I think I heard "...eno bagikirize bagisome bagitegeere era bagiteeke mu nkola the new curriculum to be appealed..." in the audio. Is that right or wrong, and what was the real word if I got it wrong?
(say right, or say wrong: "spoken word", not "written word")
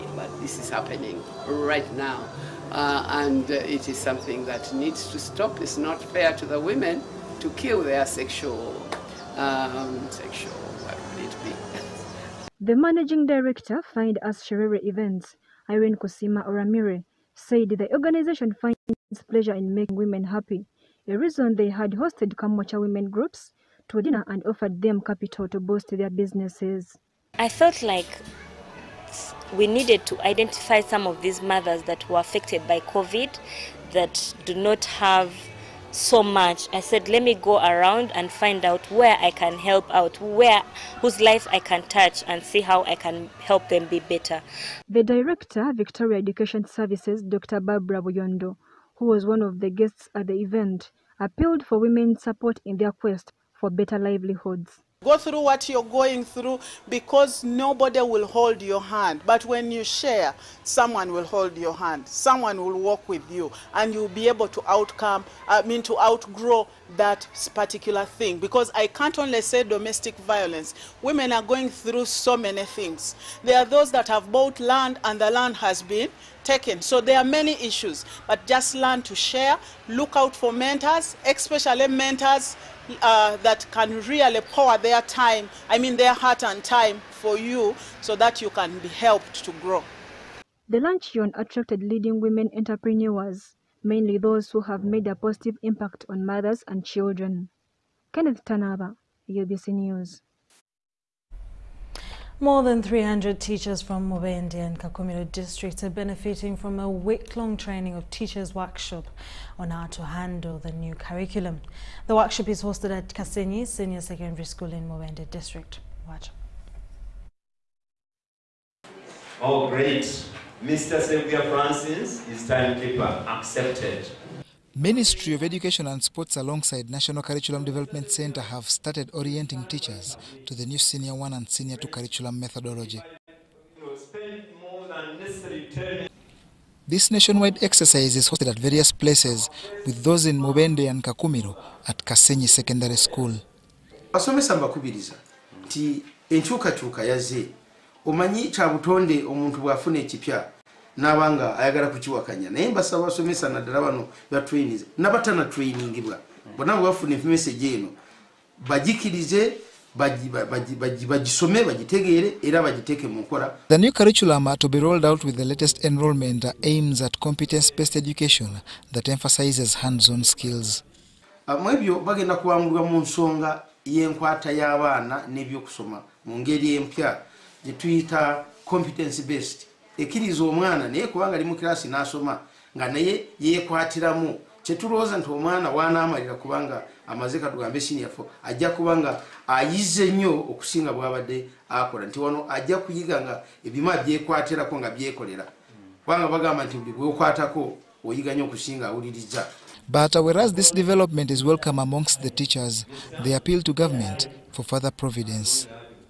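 wrong: "rolled", not "appealed".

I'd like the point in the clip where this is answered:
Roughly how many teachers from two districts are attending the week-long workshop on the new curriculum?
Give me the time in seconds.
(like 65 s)
102 s.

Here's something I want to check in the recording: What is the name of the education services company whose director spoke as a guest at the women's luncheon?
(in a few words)
Victoria Education Services.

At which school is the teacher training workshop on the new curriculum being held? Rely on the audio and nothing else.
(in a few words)
Kasenyi Senior Secondary School.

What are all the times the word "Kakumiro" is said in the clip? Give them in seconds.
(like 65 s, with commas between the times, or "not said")
104 s, 141 s.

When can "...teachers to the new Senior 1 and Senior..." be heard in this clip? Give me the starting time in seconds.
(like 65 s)
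129 s.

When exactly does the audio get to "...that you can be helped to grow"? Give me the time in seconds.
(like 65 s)
88 s.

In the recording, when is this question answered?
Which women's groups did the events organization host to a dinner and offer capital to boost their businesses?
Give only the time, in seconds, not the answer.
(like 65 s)
22 s.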